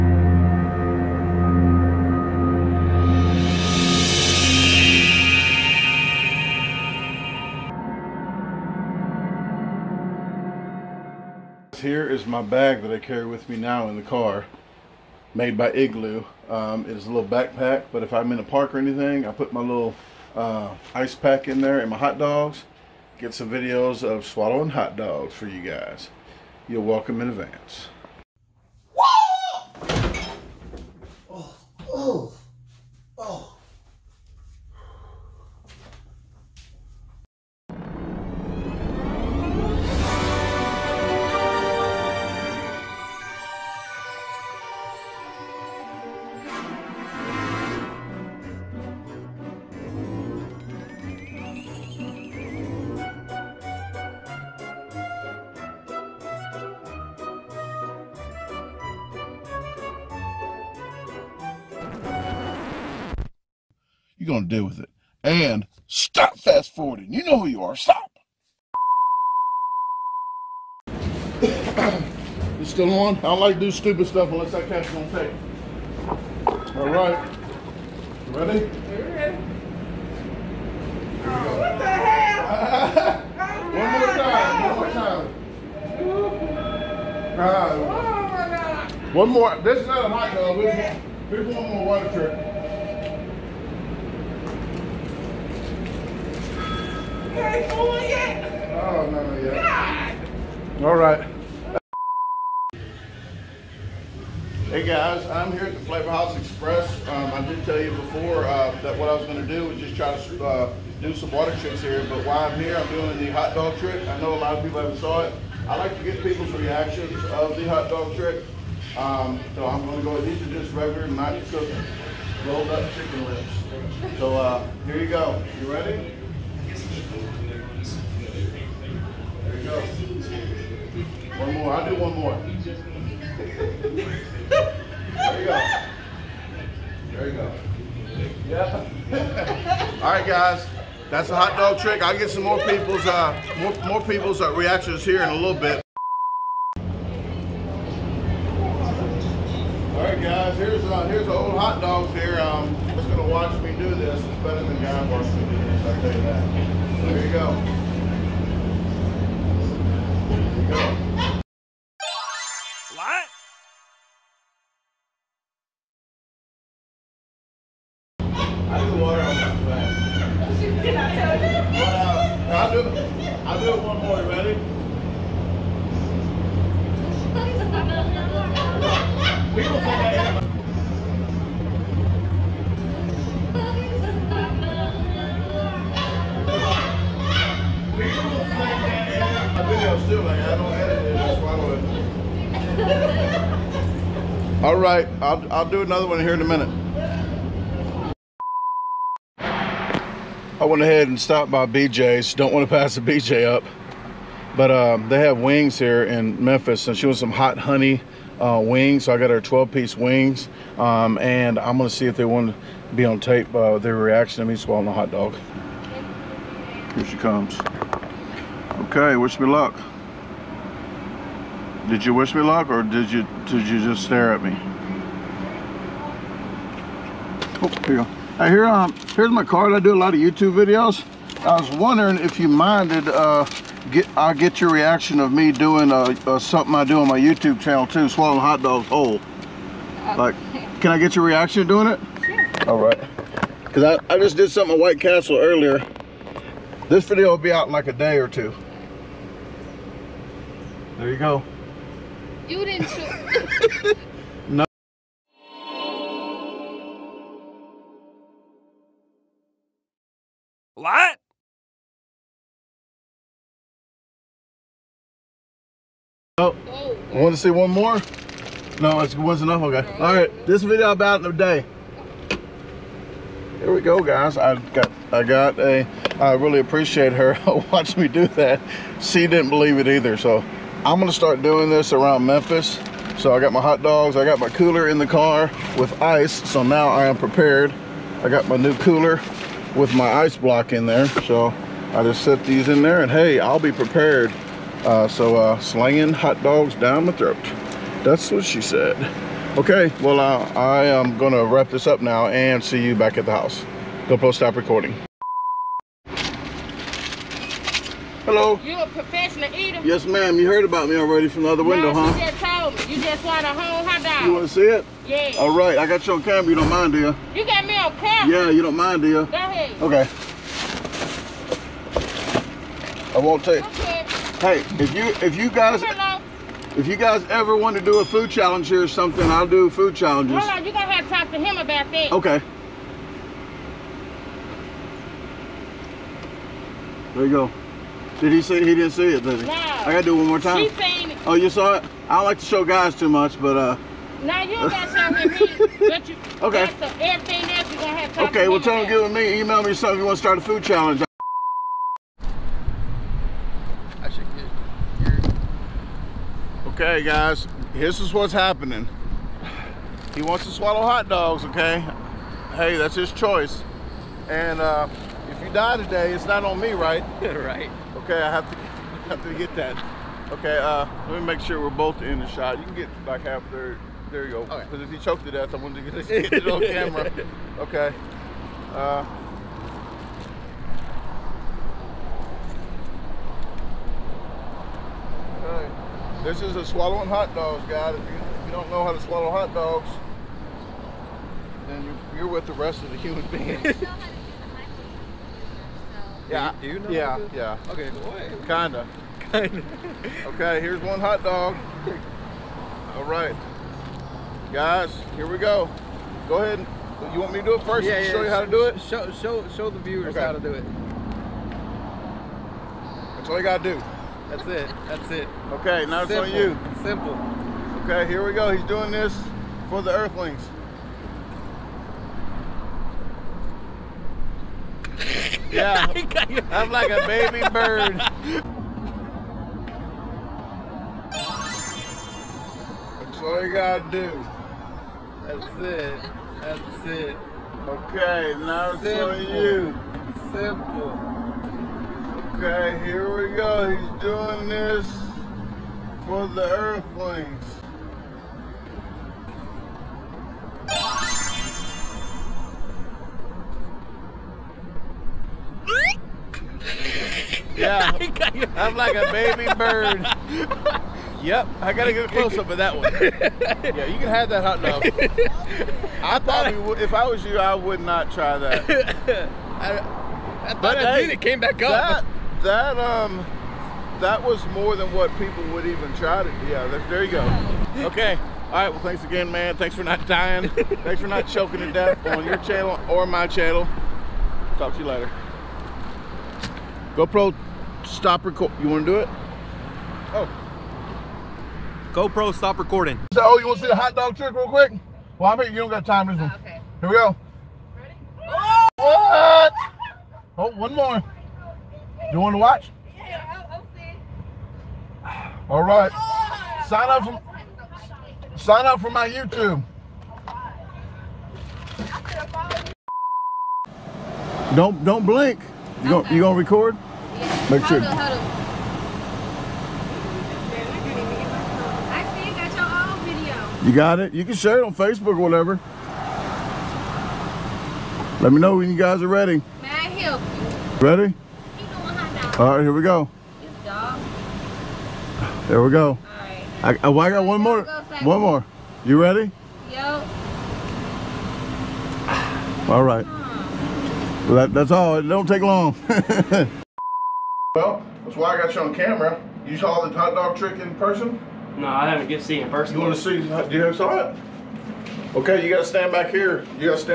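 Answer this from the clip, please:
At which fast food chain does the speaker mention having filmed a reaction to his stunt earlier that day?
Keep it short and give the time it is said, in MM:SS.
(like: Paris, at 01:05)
White Castle, at 04:04.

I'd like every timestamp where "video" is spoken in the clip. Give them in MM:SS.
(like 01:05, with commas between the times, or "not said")
00:23, 03:50, 04:07, 04:30, 08:43.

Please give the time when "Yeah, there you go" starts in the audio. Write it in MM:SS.
07:56.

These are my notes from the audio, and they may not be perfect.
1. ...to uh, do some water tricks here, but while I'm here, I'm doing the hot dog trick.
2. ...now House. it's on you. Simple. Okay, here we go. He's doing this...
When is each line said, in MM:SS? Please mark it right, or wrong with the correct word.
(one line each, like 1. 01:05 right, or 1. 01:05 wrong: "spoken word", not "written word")
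1. 01:50 right
2. 06:55 wrong: "Simple", not "House".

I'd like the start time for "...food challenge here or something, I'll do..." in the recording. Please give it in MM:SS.
05:28.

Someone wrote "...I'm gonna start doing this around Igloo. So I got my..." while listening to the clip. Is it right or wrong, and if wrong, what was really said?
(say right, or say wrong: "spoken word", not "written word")
wrong: "Memphis", not "Igloo".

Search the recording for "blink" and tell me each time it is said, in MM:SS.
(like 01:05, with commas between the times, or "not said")
08:35.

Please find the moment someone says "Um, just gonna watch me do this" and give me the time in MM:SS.
02:32.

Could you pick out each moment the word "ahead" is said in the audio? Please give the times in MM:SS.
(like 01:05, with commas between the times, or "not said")
03:20, 05:19, 06:46.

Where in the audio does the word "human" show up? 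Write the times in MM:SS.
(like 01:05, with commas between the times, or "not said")
06:32.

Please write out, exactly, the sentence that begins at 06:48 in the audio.
Show, show, show the viewers okay.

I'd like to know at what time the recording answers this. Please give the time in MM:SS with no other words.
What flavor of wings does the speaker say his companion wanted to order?
03:27.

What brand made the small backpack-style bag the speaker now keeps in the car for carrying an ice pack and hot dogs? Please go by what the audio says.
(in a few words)
Igloo.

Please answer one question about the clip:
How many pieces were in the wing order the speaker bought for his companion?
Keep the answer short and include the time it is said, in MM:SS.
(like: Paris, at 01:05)
12, at 03:29.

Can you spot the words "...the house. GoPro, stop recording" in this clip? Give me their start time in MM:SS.
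05:03.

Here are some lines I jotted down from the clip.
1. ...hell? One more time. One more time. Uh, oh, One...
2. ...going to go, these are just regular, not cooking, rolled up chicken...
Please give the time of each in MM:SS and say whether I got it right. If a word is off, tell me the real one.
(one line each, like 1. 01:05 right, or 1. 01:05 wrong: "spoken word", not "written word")
1. 01:21 right
2. 01:59 right.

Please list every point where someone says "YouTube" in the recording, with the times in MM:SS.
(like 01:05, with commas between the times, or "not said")
03:50, 03:57, 08:29.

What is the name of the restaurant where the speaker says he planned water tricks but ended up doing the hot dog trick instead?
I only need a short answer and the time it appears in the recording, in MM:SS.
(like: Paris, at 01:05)
Flavor House Express, at 01:45.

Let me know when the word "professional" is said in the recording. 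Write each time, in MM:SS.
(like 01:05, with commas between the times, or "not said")
05:08.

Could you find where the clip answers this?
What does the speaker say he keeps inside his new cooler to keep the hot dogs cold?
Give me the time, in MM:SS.
04:50.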